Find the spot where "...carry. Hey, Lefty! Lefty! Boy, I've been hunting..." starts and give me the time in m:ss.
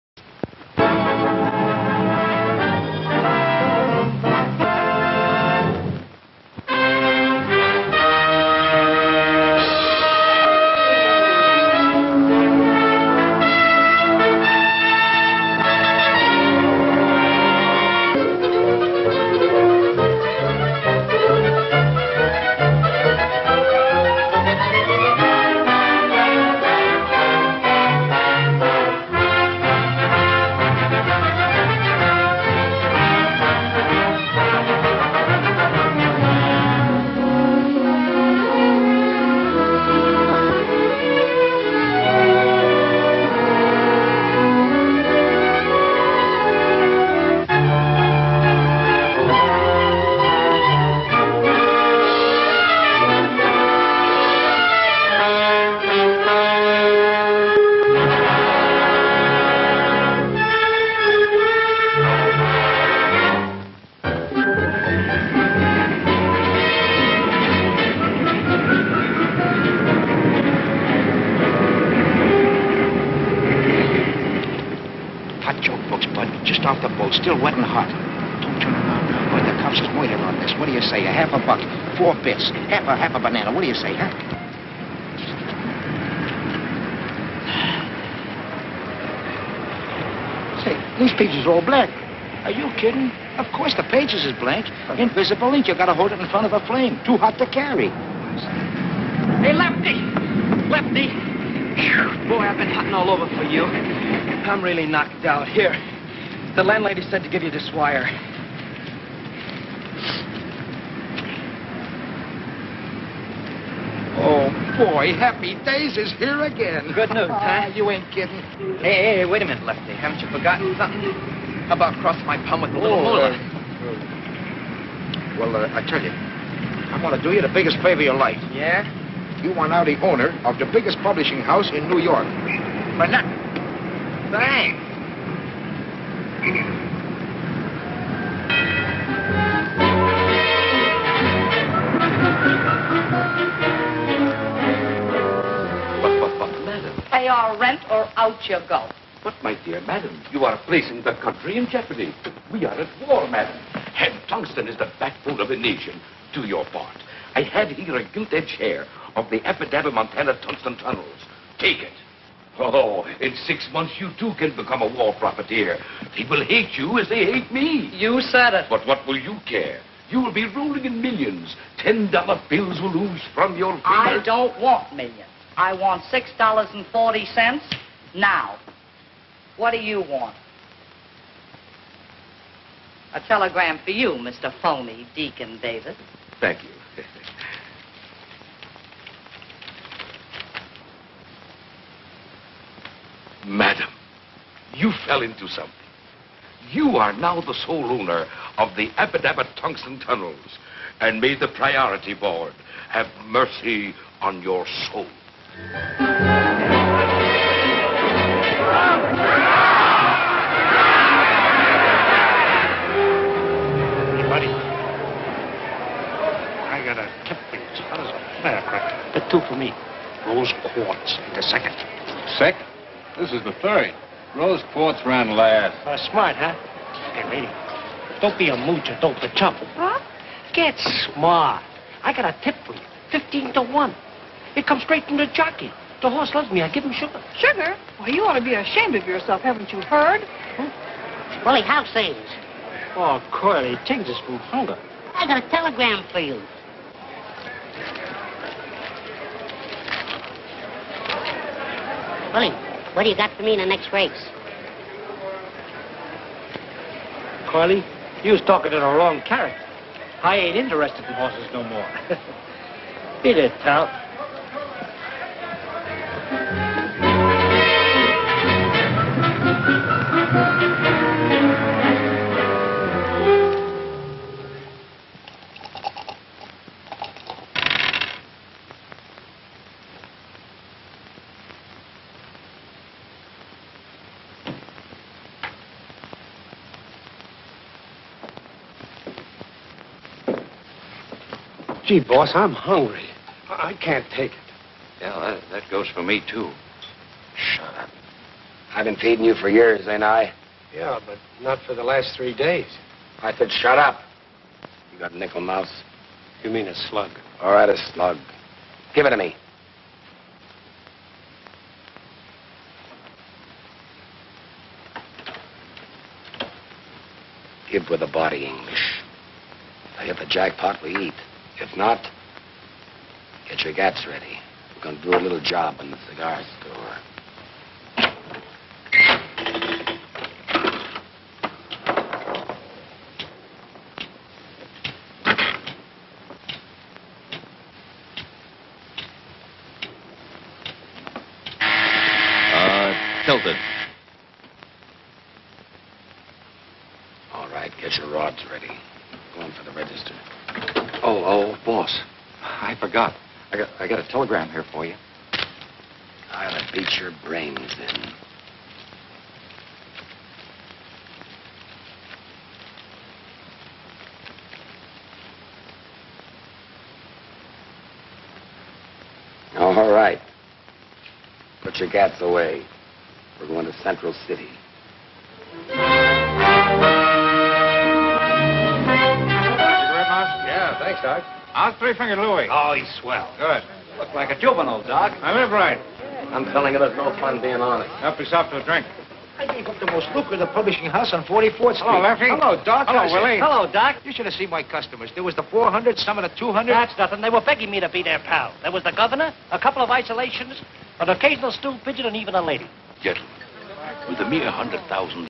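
1:37.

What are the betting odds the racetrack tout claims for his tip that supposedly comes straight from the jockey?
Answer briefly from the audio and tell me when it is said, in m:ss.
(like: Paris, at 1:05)
15 to 1, at 3:53.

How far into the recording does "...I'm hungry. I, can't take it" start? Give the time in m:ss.
4:52.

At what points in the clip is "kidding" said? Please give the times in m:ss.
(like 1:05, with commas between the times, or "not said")
1:32, 1:58.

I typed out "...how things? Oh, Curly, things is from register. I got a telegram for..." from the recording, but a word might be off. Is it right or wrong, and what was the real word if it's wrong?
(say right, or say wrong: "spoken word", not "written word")
wrong: "hunger", not "register".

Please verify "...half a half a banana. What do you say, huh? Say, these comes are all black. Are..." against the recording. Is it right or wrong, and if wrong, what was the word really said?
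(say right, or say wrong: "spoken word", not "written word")
wrong: "pages", not "comes".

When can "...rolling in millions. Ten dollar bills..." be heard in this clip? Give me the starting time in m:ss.
2:50.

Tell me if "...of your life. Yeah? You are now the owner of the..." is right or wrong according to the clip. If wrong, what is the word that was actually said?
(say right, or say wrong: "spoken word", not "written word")
right.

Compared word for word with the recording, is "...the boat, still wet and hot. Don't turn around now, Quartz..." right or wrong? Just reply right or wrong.
wrong.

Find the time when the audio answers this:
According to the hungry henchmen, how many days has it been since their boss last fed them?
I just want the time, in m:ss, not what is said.
5:02.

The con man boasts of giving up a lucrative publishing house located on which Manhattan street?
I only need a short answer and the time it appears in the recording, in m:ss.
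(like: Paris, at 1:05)
44th Street, at 6:31.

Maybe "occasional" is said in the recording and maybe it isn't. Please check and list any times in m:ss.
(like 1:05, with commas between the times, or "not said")
6:41.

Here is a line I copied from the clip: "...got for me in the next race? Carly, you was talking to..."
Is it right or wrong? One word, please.
right.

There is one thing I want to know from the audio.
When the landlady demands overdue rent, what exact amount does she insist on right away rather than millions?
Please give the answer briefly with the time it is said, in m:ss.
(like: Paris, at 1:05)
$6.40, at 2:56.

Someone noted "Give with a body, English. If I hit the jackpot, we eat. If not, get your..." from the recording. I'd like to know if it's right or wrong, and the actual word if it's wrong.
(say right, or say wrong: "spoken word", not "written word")
right.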